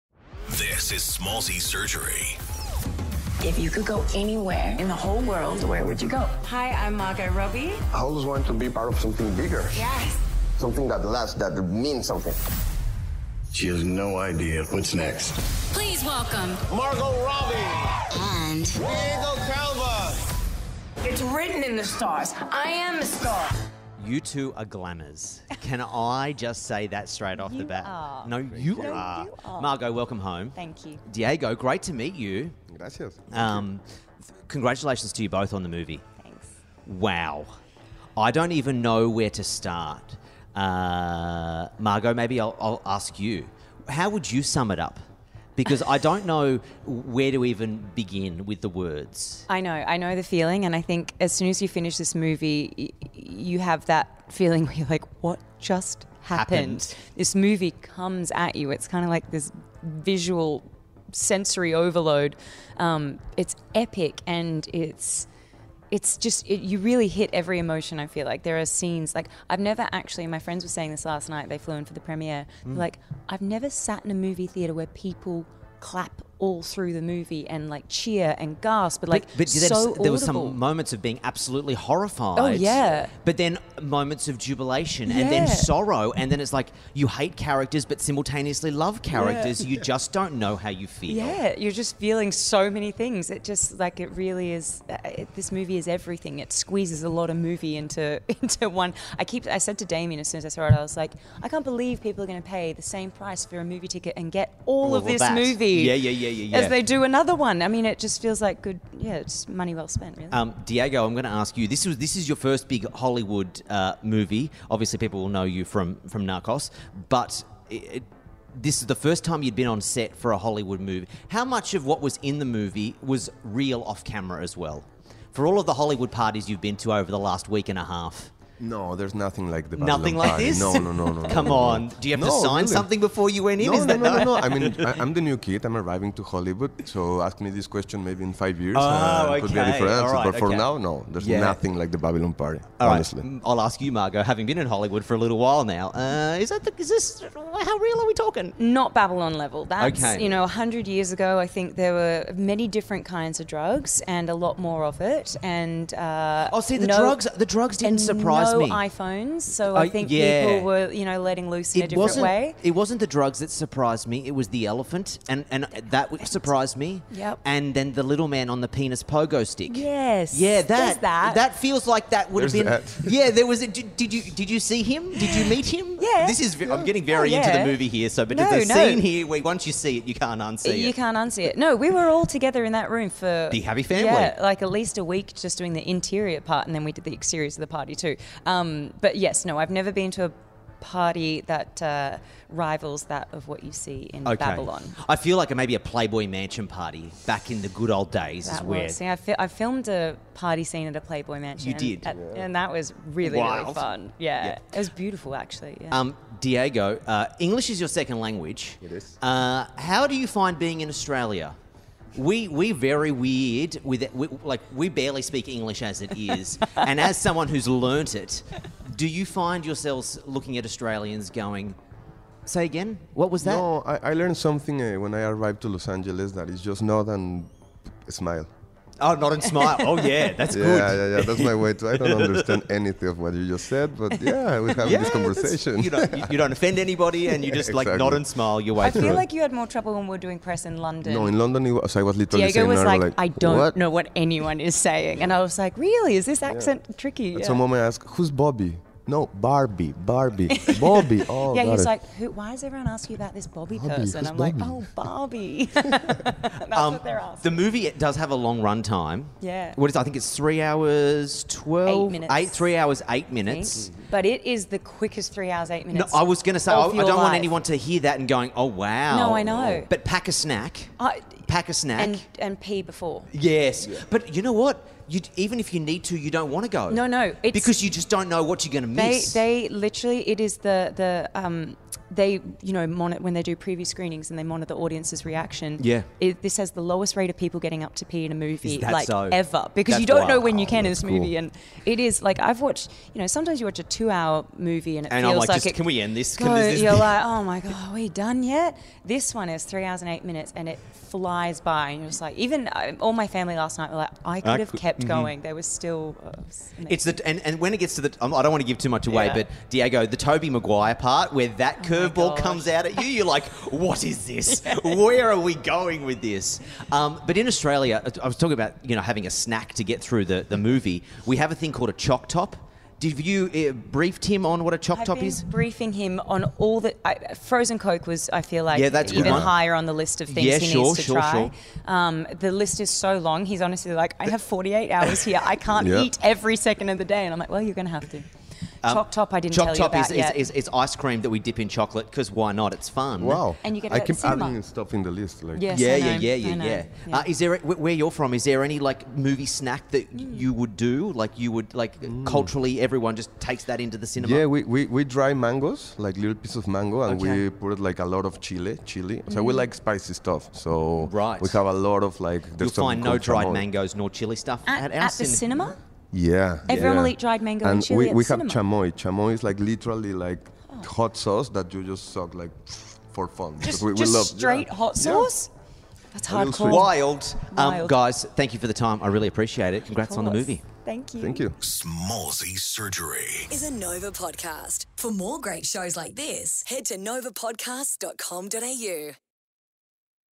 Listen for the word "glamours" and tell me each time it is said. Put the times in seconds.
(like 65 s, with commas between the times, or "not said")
24 s.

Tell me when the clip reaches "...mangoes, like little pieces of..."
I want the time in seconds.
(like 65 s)
355 s.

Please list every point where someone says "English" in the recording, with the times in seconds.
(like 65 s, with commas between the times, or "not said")
207 s, 215 s.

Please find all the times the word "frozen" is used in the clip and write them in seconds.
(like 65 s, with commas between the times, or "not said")
327 s.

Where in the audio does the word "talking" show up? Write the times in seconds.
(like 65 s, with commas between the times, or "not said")
148 s, 318 s.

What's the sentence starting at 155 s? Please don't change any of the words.
And uh, oh, see, the no, drugs, the drugs didn't surprise me.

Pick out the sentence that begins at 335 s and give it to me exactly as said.
I can't eat every second of the day, and I'm like, well, you're going to have to.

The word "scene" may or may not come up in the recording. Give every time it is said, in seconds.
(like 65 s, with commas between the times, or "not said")
68 s, 178 s, 200 s.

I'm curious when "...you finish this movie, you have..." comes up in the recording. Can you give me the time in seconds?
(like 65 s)
51 s.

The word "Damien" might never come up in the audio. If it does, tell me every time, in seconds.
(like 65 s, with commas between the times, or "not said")
99 s.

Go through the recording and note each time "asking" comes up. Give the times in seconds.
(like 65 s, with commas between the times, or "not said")
252 s, 257 s.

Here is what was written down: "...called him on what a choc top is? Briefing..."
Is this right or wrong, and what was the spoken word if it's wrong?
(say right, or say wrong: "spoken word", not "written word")
wrong: "briefed", not "called".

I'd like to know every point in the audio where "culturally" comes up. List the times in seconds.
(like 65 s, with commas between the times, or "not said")
352 s.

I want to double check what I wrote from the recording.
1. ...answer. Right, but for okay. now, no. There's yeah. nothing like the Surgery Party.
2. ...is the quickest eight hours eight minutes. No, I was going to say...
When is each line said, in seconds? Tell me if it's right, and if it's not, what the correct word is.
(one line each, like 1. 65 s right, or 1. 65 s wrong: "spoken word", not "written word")
1. 139 s wrong: "Babylon", not "Surgery"
2. 264 s wrong: "three", not "eight".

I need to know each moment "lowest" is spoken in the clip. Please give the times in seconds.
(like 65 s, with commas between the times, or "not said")
286 s.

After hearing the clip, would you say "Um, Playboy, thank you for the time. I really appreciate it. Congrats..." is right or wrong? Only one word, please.
wrong.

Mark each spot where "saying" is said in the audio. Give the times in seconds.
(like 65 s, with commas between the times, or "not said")
70 s, 244 s.